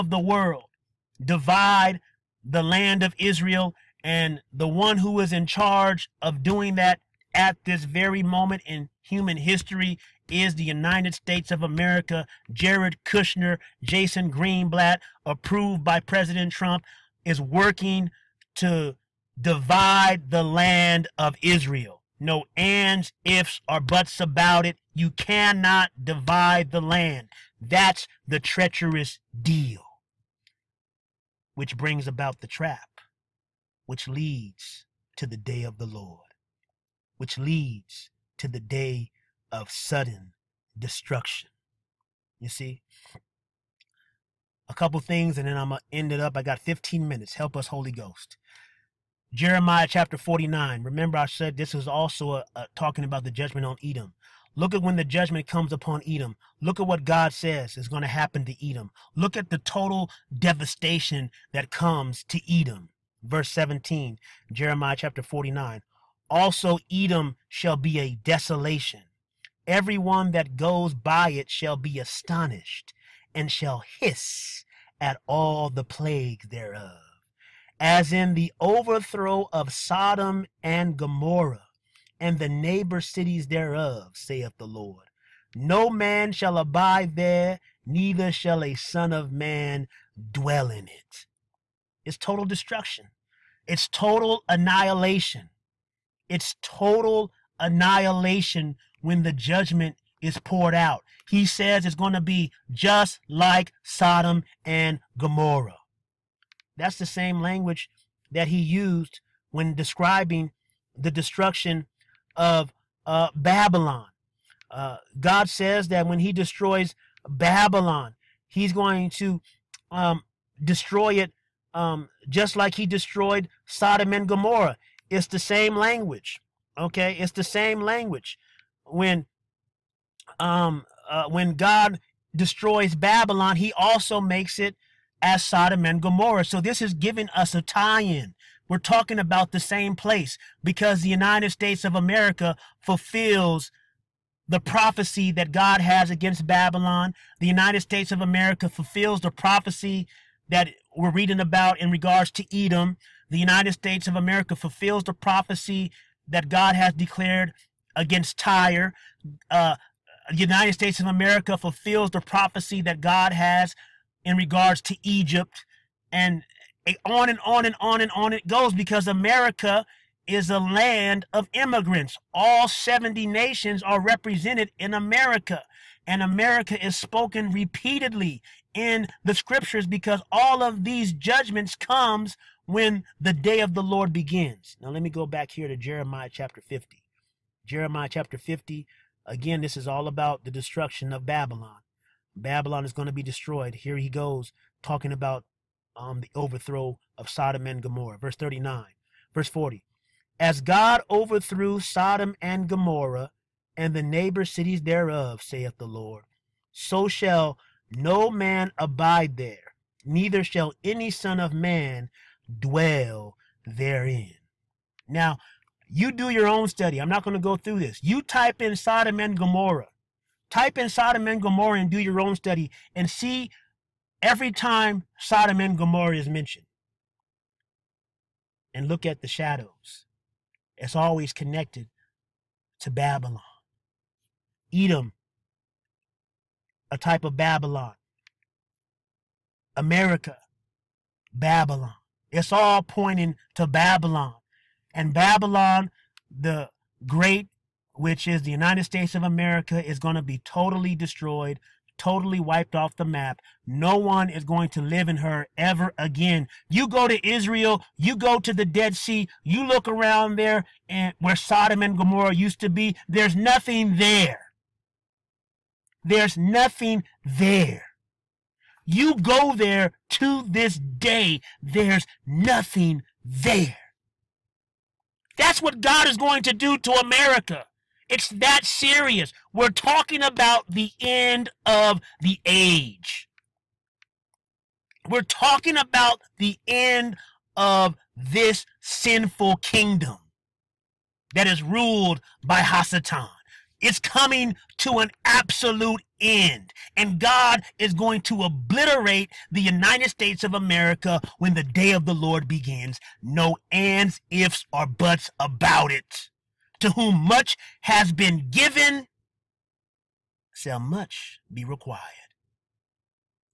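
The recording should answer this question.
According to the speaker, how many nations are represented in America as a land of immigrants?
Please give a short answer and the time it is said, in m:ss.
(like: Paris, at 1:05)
70, at 2:52.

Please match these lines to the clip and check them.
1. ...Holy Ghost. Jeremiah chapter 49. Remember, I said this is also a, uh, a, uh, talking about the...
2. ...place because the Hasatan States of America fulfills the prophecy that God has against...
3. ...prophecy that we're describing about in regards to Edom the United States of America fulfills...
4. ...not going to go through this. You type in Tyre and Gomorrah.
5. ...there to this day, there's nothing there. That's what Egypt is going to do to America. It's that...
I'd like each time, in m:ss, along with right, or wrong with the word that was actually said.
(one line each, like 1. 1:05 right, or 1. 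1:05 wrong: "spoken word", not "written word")
1. 0:47 right
2. 2:19 wrong: "United", not "Hasatan"
3. 2:29 wrong: "reading", not "describing"
4. 3:37 wrong: "Sodom", not "Tyre"
5. 4:29 wrong: "God", not "Egypt".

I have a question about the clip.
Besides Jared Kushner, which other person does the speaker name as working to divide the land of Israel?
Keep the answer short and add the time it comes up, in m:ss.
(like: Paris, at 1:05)
Jason Greenblatt, at 0:13.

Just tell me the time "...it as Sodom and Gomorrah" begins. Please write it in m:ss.
2:14.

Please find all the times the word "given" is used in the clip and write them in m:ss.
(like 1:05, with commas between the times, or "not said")
5:08.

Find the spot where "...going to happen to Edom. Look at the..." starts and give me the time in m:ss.
0:57.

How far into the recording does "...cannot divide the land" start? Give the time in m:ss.
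0:25.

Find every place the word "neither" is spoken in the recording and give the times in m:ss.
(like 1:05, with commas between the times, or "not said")
1:27, 3:30.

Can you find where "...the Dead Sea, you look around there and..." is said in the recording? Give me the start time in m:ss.
4:18.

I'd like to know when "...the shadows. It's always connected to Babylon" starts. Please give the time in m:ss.
3:49.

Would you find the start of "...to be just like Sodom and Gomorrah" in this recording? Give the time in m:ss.
1:42.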